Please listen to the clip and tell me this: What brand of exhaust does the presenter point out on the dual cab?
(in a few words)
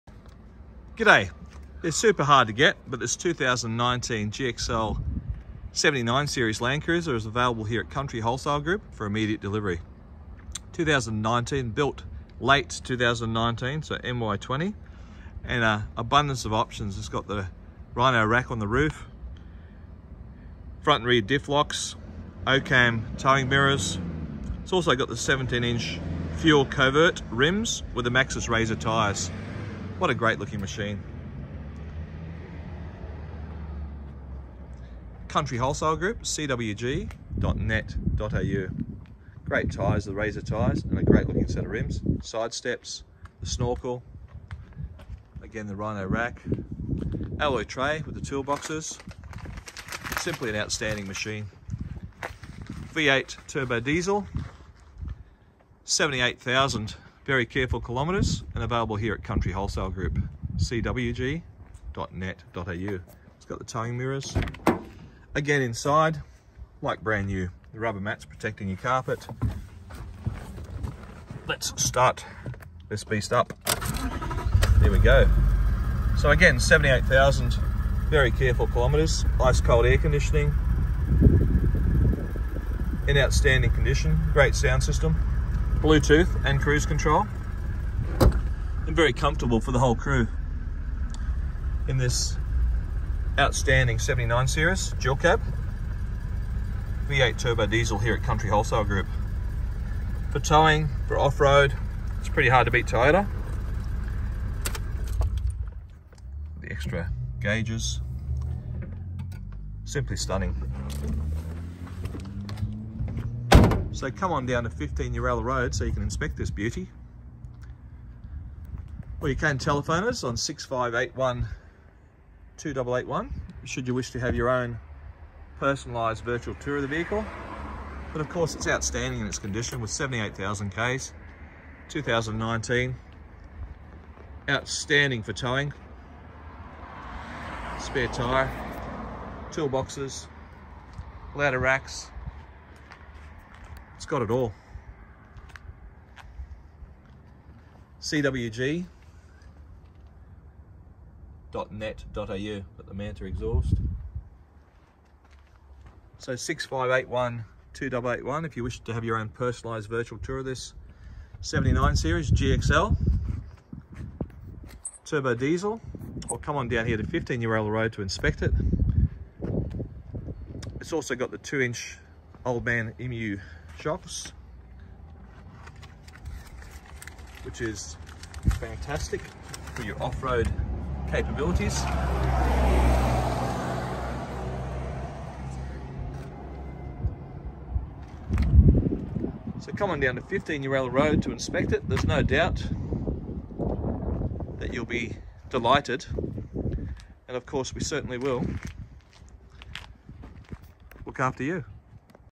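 Manta.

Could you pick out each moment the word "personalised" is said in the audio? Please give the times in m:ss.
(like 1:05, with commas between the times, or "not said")
2:05, 2:39.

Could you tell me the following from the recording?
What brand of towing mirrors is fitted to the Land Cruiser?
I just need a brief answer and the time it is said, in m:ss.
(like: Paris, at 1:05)
OCAM, at 0:22.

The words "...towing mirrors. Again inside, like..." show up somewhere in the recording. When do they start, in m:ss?
1:03.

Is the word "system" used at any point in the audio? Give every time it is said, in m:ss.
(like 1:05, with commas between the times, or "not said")
1:24.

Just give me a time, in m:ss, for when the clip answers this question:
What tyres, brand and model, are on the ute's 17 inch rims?
0:28.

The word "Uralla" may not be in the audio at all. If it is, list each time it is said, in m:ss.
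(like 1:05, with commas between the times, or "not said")
1:55, 2:47, 3:10.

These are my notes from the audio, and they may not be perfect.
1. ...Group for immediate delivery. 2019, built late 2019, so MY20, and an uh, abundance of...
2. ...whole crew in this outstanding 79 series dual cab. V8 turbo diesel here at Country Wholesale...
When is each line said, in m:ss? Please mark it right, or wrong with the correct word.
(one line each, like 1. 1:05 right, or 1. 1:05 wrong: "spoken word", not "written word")
1. 0:08 right
2. 1:29 right.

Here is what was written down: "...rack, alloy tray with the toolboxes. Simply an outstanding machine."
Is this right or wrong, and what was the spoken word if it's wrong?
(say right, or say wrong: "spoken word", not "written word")
right.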